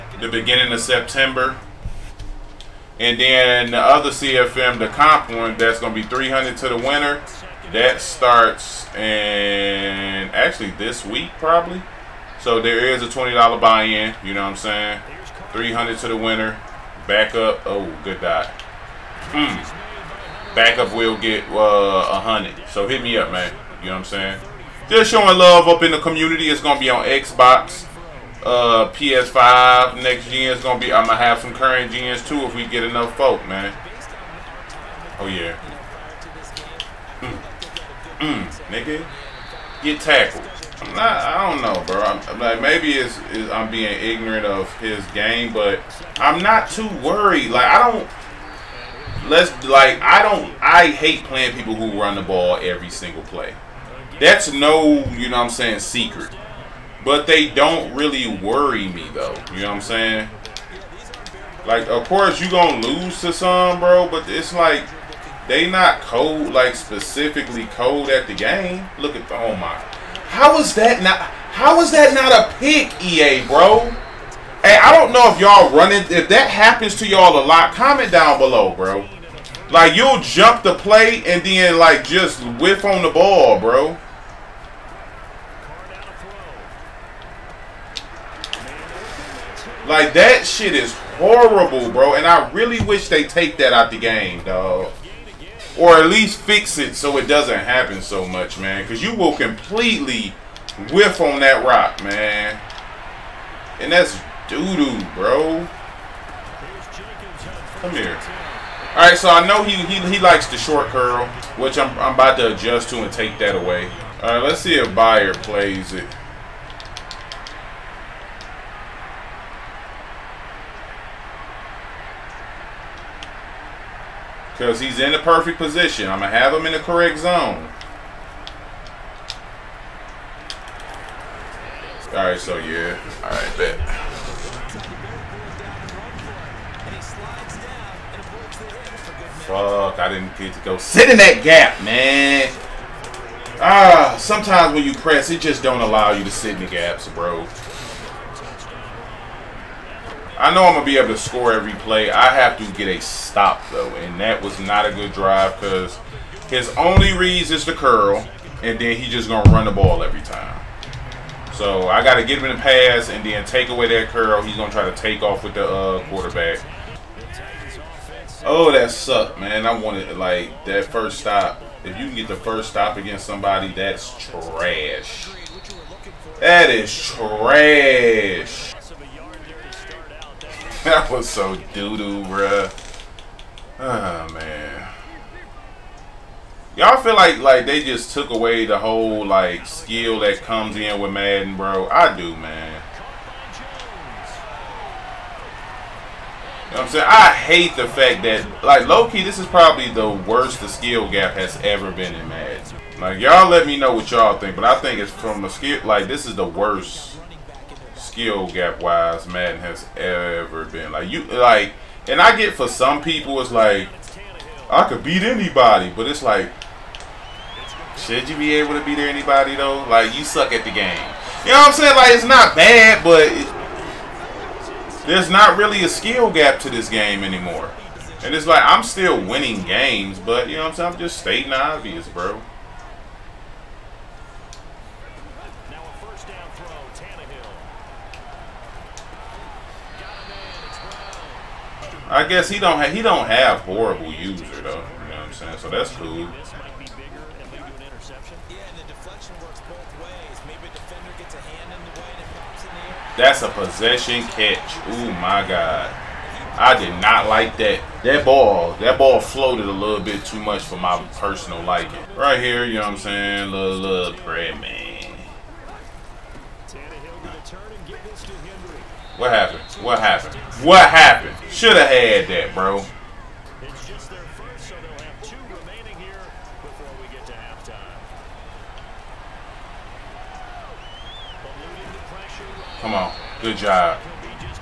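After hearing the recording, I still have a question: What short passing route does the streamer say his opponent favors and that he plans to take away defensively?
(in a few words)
Short curl.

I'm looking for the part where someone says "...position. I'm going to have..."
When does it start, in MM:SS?
02:05.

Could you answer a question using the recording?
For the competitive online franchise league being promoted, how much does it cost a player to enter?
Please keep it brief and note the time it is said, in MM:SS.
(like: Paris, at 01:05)
$20, at 00:13.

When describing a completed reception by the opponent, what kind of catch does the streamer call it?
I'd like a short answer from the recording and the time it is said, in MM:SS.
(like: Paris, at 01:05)
Possession catch, at 04:13.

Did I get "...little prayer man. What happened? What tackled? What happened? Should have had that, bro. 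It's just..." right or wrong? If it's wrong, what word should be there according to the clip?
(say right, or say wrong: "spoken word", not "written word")
wrong: "happened", not "tackled".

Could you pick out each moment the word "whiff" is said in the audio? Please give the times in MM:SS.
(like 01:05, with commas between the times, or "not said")
01:22, 01:40.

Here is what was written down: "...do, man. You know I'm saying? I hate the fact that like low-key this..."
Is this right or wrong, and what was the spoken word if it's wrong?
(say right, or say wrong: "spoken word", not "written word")
right.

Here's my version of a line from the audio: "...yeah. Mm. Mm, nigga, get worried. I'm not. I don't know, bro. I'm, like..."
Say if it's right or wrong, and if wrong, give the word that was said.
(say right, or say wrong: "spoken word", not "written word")
wrong: "tackled", not "worried".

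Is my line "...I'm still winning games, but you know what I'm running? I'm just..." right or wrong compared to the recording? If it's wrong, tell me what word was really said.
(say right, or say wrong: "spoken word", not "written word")
wrong: "saying", not "running".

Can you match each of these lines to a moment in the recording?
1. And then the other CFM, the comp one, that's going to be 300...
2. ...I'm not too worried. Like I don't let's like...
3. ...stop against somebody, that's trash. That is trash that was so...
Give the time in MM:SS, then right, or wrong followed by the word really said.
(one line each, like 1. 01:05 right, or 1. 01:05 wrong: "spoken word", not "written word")
1. 00:02 right
2. 00:46 right
3. 02:52 right.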